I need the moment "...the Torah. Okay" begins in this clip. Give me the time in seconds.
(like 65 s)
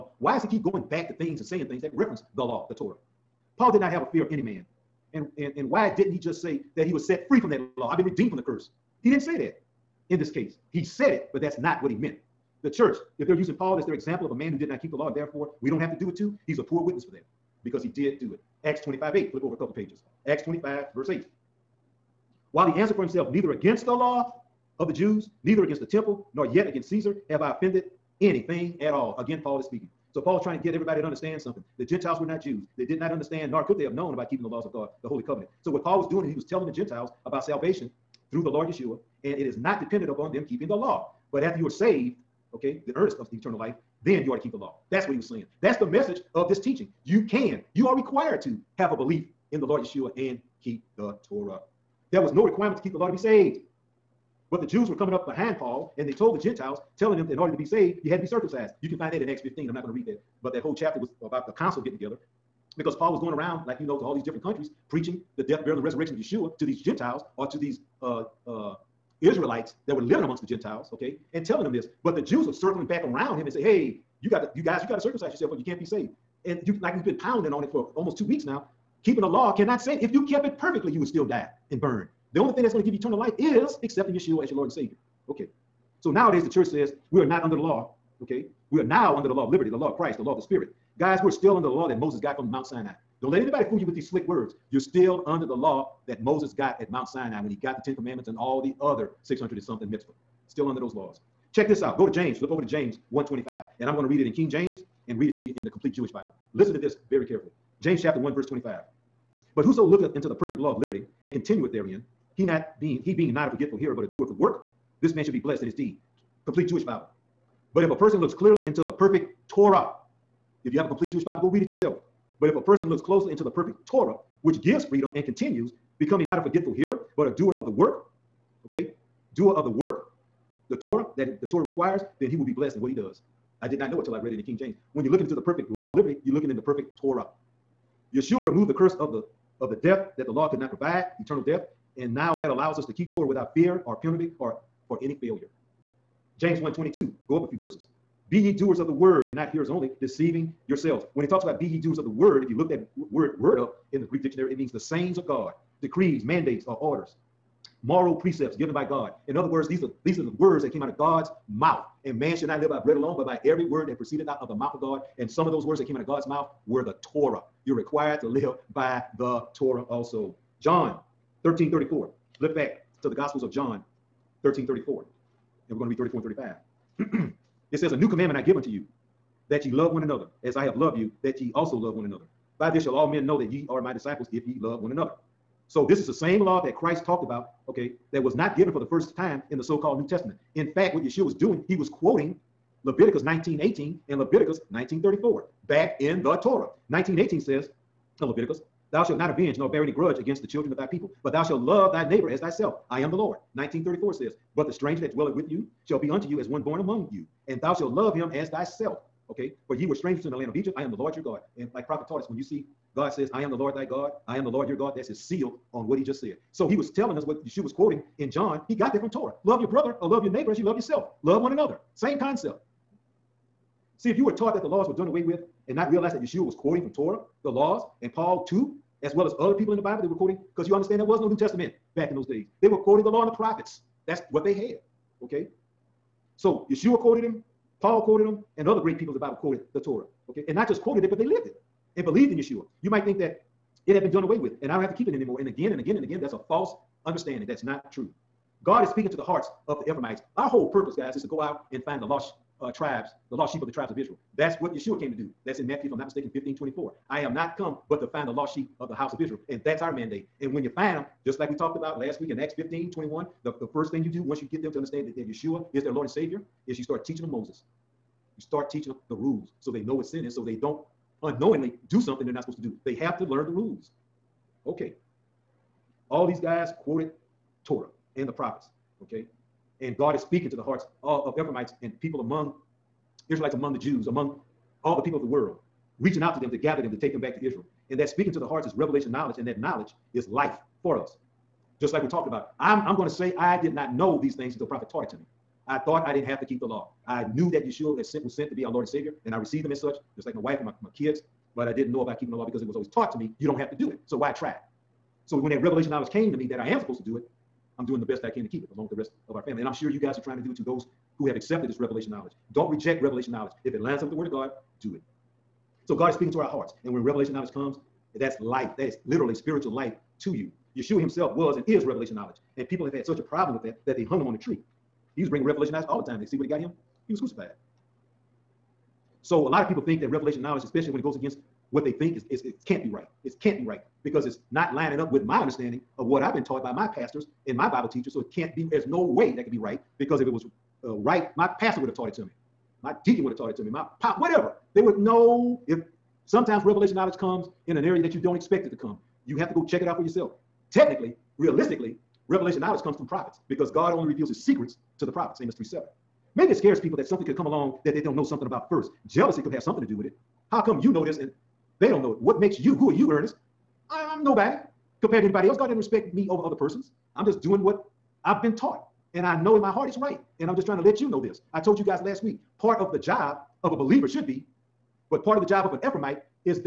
239 s.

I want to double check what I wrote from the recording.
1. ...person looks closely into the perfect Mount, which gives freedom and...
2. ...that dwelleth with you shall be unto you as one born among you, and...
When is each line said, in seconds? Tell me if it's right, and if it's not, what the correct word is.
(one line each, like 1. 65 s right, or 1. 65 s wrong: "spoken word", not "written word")
1. 122 s wrong: "Torah", not "Mount"
2. 205 s right.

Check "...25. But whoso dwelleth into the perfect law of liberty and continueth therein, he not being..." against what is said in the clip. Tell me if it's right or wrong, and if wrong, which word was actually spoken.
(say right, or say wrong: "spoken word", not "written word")
wrong: "looketh", not "dwelleth".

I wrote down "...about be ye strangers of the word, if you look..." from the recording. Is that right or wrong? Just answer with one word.
wrong.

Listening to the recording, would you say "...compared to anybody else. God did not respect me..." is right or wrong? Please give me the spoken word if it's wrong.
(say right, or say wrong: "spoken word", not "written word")
right.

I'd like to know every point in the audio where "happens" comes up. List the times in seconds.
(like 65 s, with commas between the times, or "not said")
not said.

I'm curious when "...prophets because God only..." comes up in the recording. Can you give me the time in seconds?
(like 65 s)
353 s.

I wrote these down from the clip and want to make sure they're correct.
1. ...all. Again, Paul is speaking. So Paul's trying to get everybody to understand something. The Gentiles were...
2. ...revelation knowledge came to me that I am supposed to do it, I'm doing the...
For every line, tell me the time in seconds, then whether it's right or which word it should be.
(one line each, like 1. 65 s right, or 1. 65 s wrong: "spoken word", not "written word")
1. 28 s right
2. 305 s right.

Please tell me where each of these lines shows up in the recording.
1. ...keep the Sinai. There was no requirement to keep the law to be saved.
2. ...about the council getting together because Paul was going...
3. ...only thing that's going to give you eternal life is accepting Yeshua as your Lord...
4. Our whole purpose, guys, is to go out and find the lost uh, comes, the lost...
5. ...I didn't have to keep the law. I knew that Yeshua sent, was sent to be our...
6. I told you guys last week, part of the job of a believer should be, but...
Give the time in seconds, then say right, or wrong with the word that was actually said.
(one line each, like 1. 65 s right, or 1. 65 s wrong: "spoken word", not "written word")
1. 50 s wrong: "Torah", not "Sinai"
2. 61 s right
3. 82 s right
4. 250 s wrong: "tribes", not "comes"
5. 296 s right
6. 371 s right.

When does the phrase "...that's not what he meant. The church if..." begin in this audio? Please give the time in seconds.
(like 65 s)
11 s.